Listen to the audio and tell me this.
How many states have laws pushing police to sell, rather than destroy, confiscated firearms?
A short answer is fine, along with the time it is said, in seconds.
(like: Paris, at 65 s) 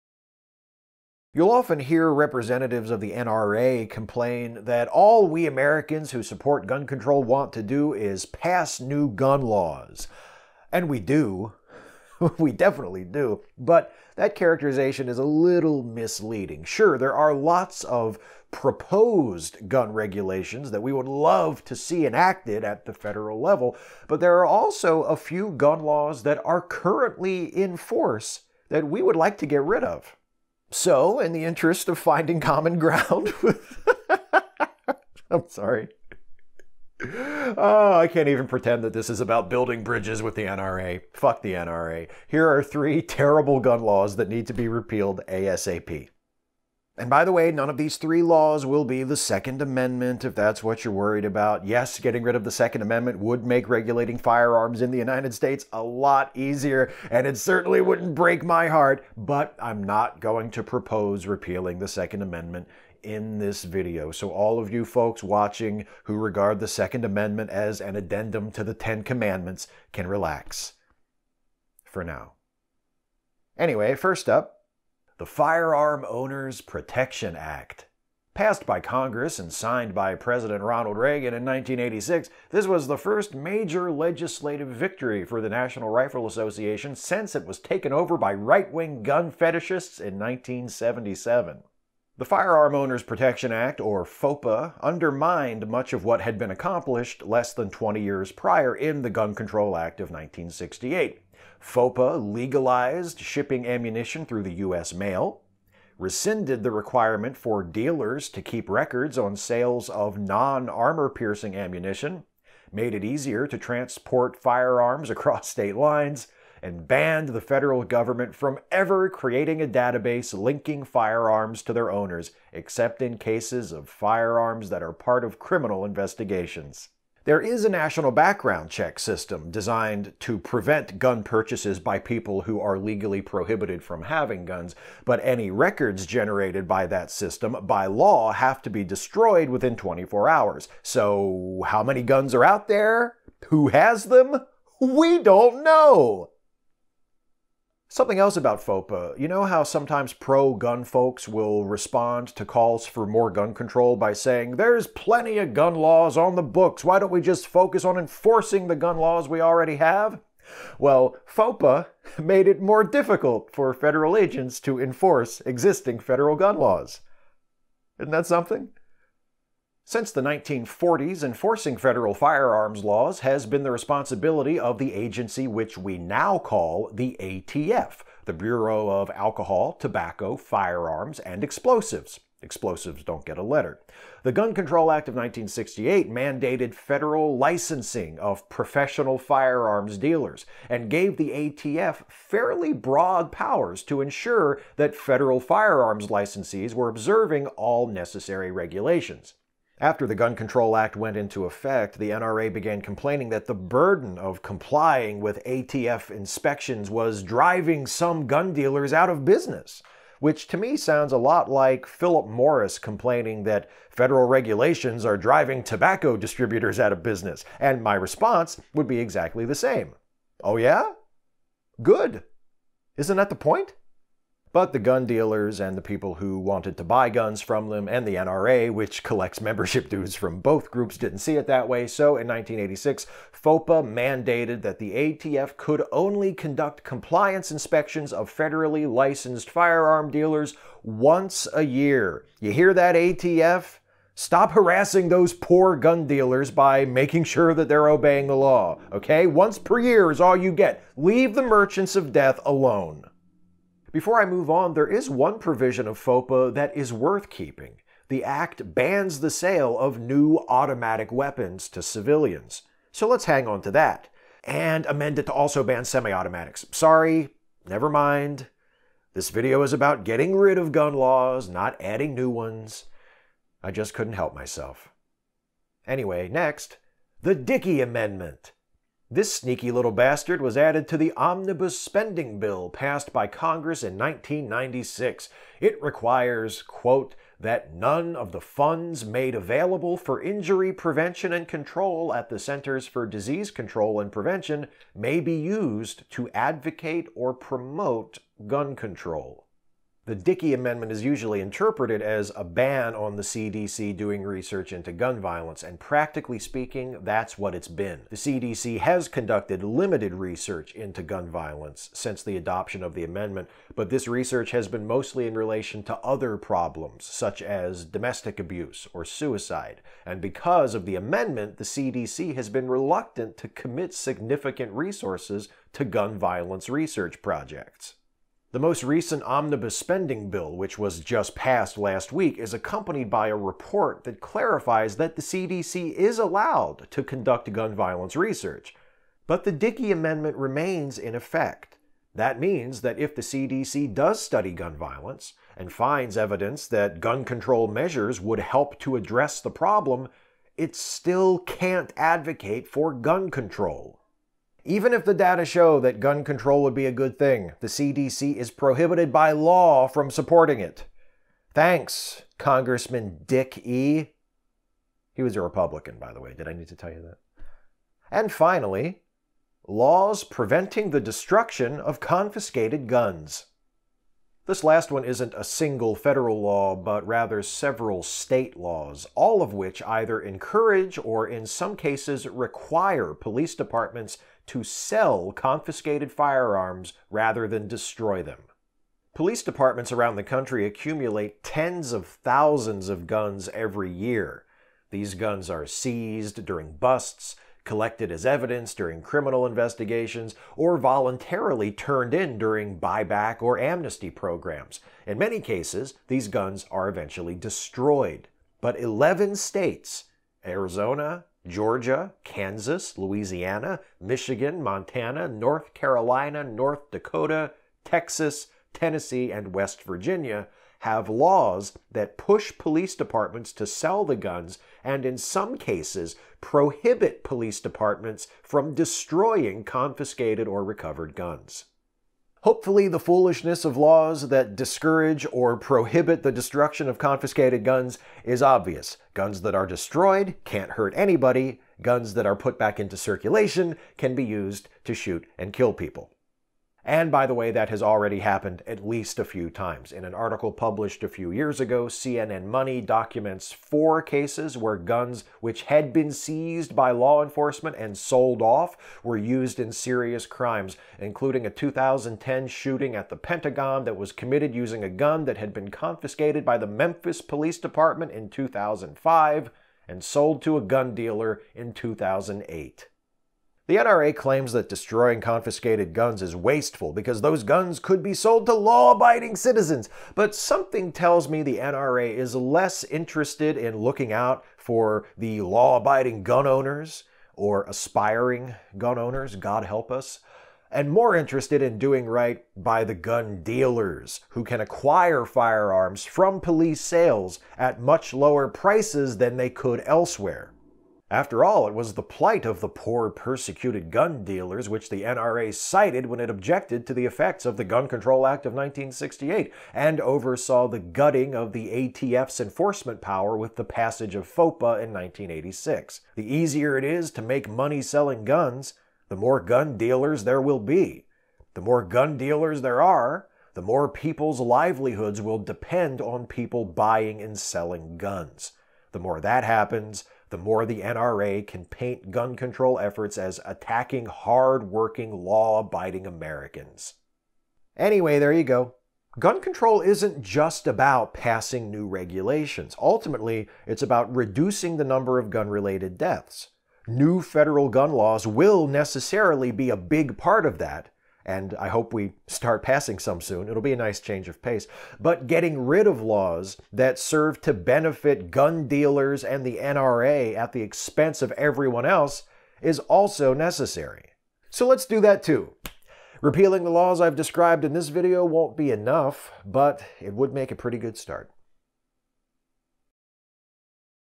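11, at 408 s.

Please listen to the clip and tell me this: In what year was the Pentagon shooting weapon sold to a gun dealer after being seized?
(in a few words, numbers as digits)
2008.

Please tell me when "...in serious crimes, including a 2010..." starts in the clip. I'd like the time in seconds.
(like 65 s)
459 s.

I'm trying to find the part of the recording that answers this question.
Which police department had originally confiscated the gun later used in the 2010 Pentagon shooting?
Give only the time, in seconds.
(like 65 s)
466 s.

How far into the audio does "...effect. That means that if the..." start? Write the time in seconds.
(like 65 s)
341 s.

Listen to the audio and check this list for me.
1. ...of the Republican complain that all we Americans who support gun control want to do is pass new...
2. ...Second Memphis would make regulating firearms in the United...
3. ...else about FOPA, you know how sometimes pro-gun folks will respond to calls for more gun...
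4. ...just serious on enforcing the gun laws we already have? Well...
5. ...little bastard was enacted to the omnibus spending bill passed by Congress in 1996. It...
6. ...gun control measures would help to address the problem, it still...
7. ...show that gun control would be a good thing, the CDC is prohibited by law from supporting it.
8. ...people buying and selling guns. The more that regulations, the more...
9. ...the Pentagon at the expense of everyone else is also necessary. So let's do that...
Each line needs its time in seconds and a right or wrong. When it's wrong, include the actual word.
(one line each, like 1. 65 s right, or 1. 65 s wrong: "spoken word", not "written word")
1. 2 s wrong: "NRA", not "Republican"
2. 52 s wrong: "Amendment", not "Memphis"
3. 148 s right
4. 157 s wrong: "focus", not "serious"
5. 279 s wrong: "added", not "enacted"
6. 346 s right
7. 355 s right
8. 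526 s wrong: "happens", not "regulations"
9. 559 s wrong: "NRA", not "Pentagon".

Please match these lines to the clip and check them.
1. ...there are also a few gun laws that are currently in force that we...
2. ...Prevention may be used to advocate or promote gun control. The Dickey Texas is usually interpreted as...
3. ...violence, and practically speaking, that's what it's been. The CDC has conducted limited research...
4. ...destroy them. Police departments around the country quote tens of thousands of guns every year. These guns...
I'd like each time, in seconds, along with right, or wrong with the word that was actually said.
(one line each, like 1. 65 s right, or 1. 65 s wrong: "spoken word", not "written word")
1. 24 s right
2. 294 s wrong: "Amendment", not "Texas"
3. 305 s right
4. 387 s wrong: "accumulate", not "quote".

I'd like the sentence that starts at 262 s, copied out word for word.
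So let's hang on to that.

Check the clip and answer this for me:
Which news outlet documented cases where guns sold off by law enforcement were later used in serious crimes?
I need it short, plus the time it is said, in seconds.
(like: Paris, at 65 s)
CNN Money, at 451 s.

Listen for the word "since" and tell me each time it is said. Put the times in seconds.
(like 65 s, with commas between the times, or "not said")
86 s, 169 s, 311 s.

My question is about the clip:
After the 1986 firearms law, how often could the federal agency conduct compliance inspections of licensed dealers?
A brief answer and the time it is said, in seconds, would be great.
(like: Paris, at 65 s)
once a year, at 240 s.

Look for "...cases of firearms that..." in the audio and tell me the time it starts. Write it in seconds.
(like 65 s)
123 s.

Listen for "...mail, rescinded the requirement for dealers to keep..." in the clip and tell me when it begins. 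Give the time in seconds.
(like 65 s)
104 s.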